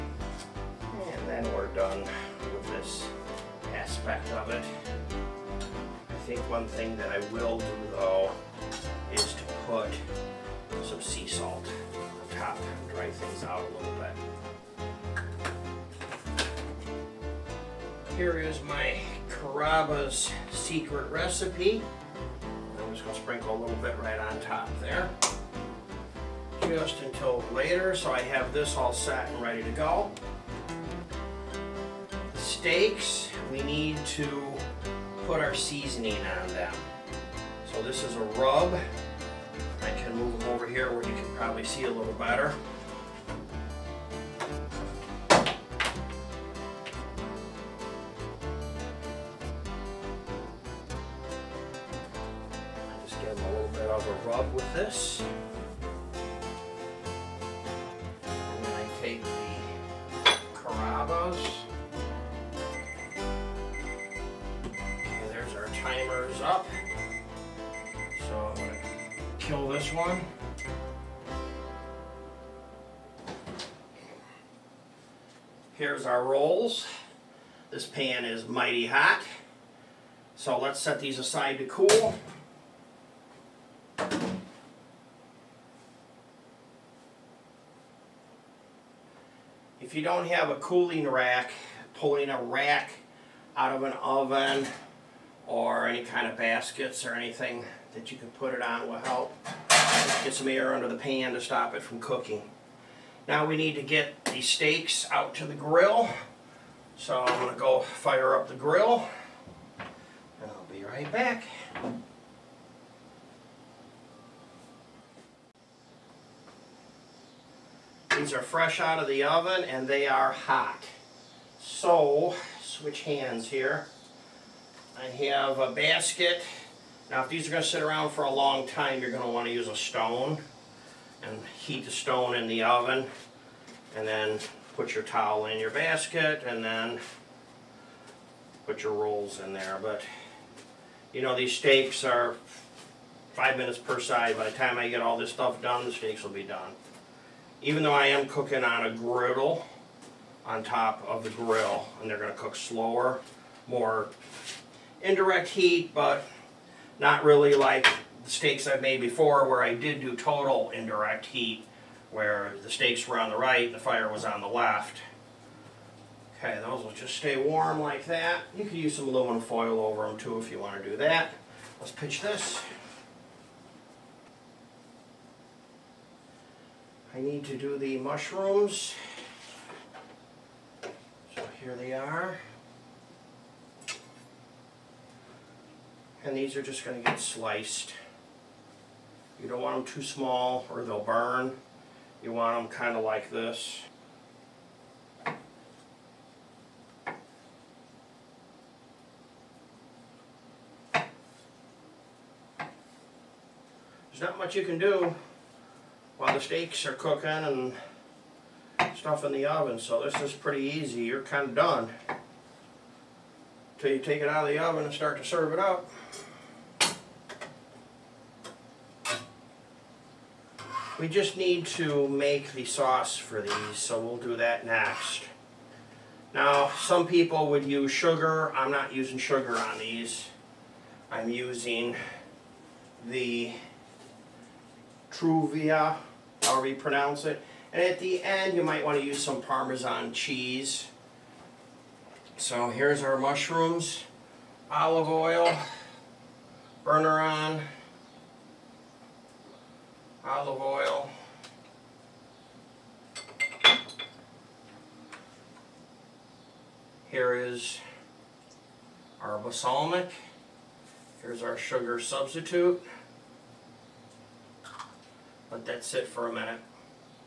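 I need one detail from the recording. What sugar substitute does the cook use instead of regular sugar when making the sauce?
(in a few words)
Truvia.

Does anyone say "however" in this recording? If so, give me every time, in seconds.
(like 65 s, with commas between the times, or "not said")
236 s.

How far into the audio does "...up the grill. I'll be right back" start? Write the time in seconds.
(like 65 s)
108 s.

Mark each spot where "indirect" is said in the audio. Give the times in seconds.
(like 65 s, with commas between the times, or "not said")
155 s, 160 s.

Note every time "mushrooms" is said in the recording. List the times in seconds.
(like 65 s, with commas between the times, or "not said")
177 s, 243 s.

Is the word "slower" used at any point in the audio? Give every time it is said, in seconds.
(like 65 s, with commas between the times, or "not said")
152 s.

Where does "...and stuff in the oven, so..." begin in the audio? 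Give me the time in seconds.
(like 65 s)
207 s.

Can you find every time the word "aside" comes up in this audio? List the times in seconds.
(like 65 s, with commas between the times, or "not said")
81 s.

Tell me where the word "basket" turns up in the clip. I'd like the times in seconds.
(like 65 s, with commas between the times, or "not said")
96 s, 125 s, 135 s.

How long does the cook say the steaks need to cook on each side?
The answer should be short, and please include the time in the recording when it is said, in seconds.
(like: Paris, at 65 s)
5 minutes, at 143 s.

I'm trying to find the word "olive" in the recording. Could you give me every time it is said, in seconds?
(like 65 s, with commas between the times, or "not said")
244 s, 250 s.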